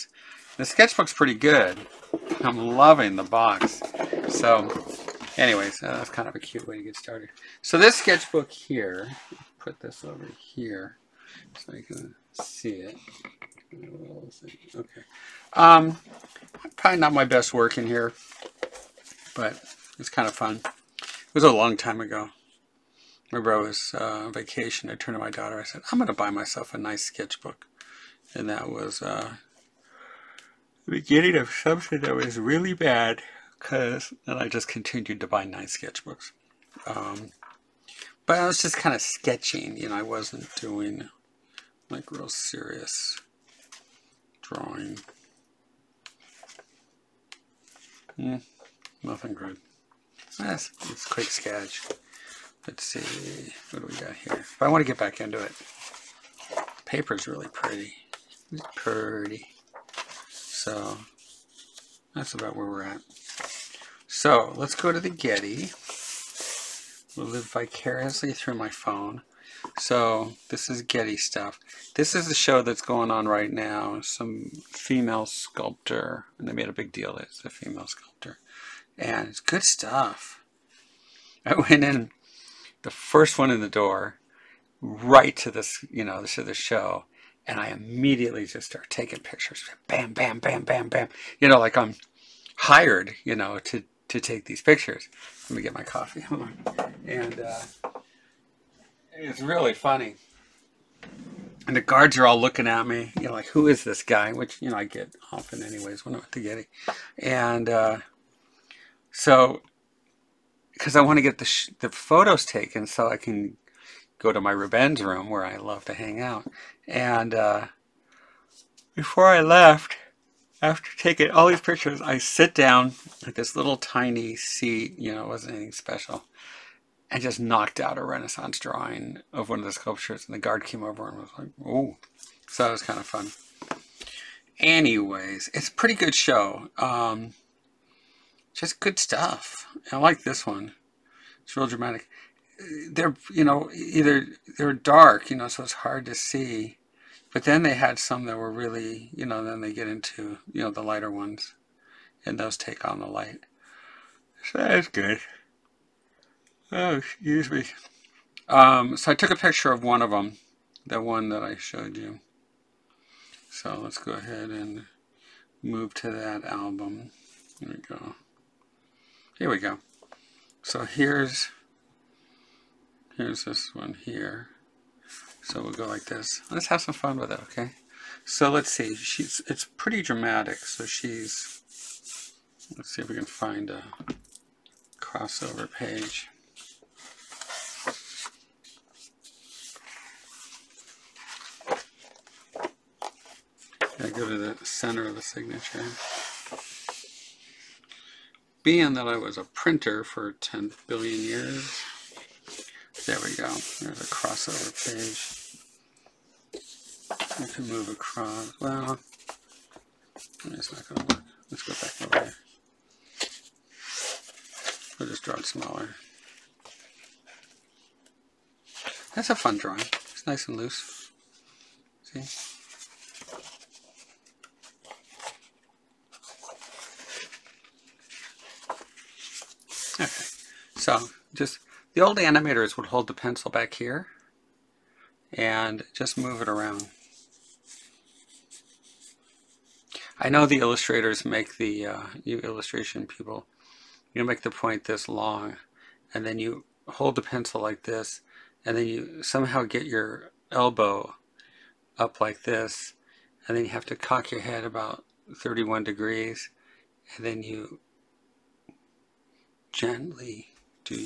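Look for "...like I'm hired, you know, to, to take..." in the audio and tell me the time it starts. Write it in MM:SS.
01:31.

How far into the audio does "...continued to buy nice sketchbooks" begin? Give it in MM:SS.
00:34.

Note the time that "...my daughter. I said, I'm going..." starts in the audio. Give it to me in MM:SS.
00:25.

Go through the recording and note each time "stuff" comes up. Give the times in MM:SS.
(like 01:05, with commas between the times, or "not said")
01:11, 01:19, 02:18.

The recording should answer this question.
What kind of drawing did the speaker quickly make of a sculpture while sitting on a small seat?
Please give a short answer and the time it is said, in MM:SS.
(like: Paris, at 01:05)
Renaissance drawing, at 02:08.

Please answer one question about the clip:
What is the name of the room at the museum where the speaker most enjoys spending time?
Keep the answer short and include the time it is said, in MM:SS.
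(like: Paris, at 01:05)
Rubens room, at 01:54.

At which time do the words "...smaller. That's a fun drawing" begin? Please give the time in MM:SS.
03:35.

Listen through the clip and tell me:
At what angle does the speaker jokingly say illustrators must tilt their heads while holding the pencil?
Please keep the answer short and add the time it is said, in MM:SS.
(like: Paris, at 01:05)
31 degrees, at 04:15.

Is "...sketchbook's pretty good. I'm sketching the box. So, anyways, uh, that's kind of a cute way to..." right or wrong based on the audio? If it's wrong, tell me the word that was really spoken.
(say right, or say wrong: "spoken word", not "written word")
wrong: "loving", not "sketching".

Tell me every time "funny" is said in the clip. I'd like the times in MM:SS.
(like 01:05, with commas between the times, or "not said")
01:39.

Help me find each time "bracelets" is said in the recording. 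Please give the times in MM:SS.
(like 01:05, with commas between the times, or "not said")
not said.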